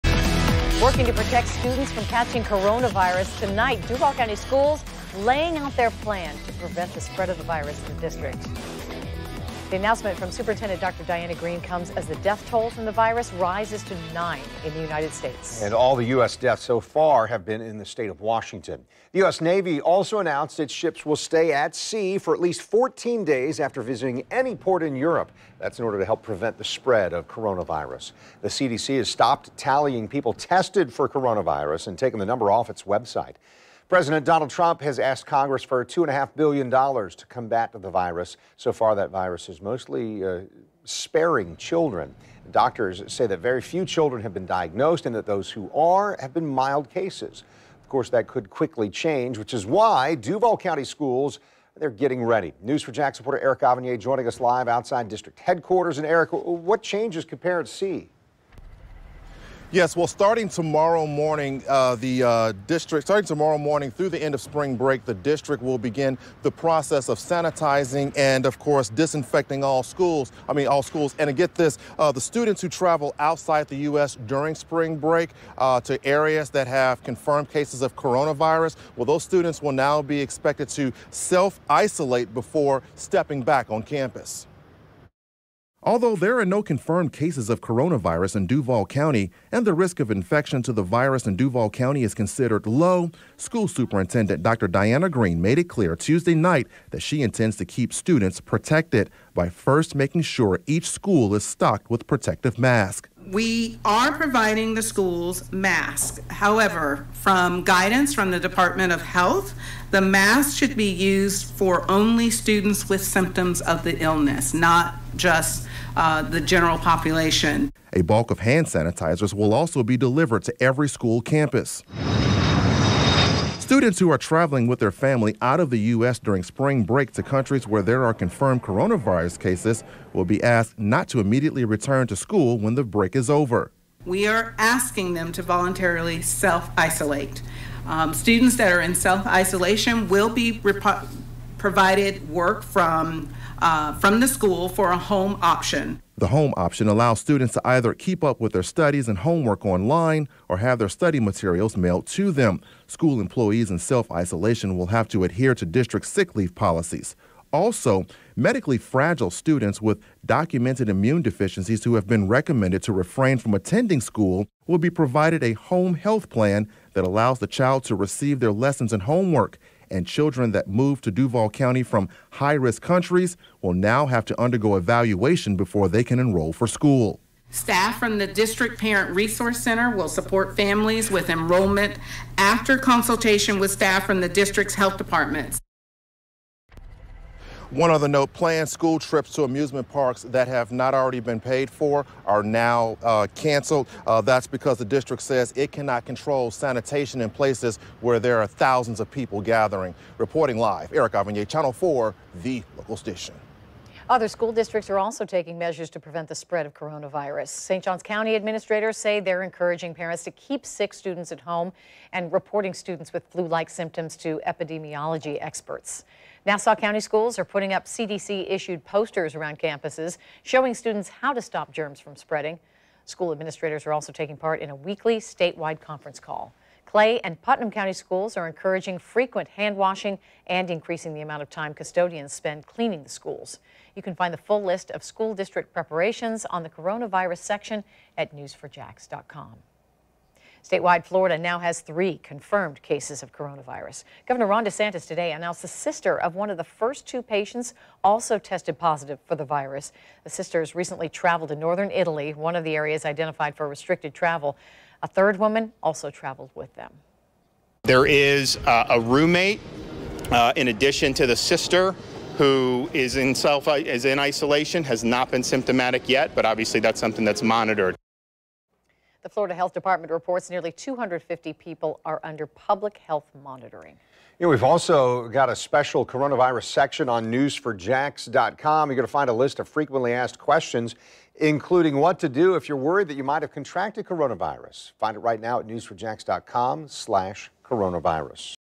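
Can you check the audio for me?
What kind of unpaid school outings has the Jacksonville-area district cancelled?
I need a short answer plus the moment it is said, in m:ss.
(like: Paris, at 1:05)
Trips to amusement parks, at 3:09.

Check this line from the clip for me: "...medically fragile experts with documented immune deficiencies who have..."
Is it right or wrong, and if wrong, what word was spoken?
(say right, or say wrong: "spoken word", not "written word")
wrong: "students", not "experts".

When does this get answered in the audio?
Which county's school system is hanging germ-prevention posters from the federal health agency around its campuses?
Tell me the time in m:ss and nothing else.
3:36.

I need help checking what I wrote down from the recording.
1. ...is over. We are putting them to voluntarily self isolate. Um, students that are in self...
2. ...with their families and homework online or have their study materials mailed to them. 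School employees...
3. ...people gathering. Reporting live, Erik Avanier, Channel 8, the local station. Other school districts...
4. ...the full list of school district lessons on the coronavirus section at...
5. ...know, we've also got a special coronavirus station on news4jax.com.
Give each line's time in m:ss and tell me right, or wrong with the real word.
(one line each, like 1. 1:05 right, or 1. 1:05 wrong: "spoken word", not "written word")
1. 2:13 wrong: "asking", not "putting"
2. 2:28 wrong: "studies", not "families"
3. 3:19 wrong: "4", not "8"
4. 3:54 wrong: "preparations", not "lessons"
5. 4:34 wrong: "section", not "station".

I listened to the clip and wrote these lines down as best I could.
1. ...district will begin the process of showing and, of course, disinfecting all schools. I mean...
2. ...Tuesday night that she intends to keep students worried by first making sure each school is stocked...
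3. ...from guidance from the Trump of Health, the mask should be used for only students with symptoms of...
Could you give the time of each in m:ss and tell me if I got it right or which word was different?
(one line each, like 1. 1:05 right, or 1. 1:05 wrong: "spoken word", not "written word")
1. 1:05 wrong: "sanitizing", not "showing"
2. 1:35 wrong: "protected", not "worried"
3. 1:47 wrong: "Department", not "Trump".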